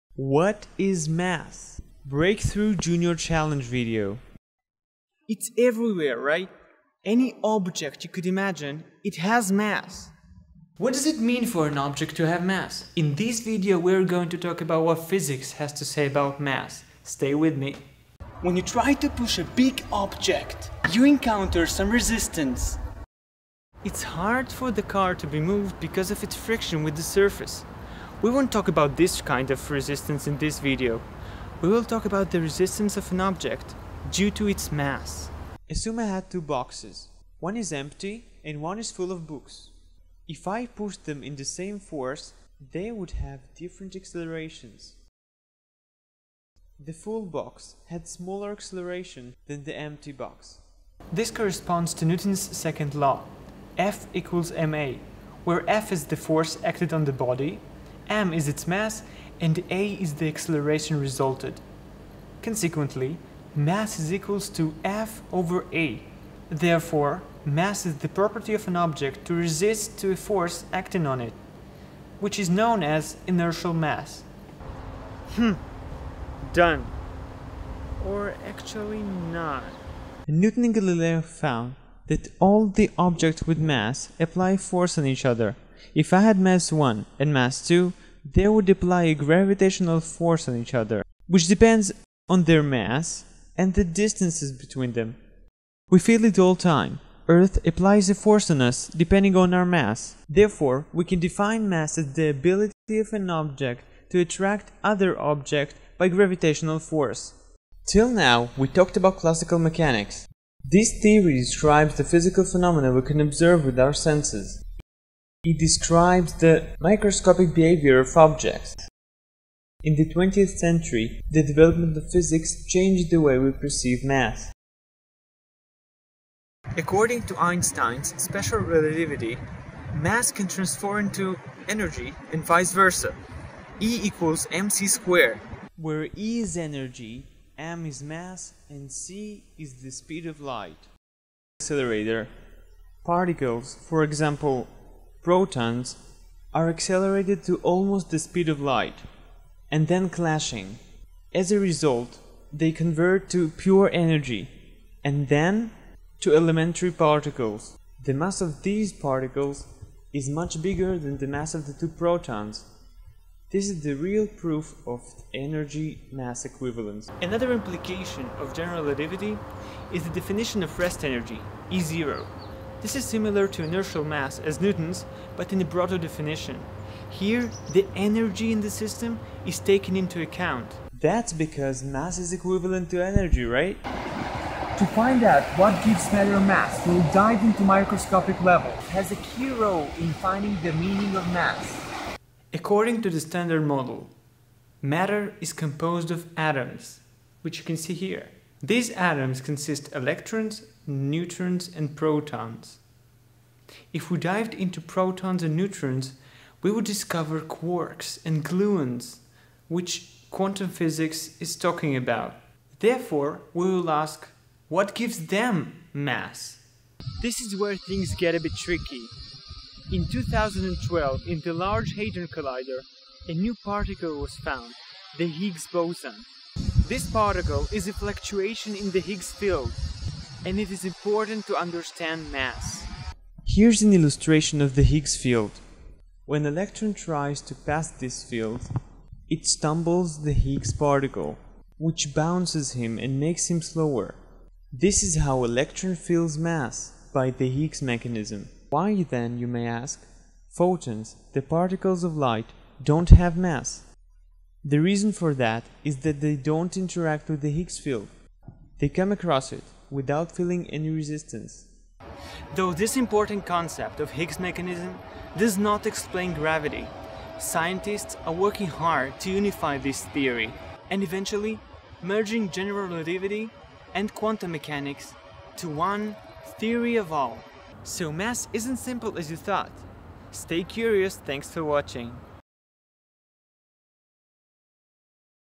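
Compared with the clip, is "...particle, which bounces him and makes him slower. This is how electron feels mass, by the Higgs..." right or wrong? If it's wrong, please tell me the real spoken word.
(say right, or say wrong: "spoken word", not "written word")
right.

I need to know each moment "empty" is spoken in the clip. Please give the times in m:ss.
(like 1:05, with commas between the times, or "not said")
0:37, 0:49.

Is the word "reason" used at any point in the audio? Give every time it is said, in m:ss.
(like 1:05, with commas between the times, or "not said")
4:14.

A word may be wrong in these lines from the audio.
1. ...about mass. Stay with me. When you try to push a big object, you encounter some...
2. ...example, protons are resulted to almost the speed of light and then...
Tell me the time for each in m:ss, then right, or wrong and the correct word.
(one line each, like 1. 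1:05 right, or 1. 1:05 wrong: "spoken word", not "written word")
1. 0:16 right
2. 2:24 wrong: "accelerated", not "resulted".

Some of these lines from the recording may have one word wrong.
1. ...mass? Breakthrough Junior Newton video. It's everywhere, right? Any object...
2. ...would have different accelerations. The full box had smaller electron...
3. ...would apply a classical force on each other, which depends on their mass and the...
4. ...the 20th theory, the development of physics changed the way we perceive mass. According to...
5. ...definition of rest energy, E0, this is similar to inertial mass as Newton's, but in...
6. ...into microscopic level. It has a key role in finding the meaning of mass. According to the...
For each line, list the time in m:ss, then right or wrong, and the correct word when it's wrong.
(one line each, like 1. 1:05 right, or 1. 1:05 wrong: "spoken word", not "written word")
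1. 0:01 wrong: "Challenge", not "Newton"
2. 0:42 wrong: "acceleration", not "electron"
3. 1:28 wrong: "gravitational", not "classical"
4. 1:59 wrong: "century", not "theory"
5. 2:50 right
6. 3:07 right.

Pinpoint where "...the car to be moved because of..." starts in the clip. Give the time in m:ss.
0:24.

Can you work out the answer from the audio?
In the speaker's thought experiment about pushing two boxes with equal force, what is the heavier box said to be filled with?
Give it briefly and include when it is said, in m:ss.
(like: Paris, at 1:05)
books, at 0:38.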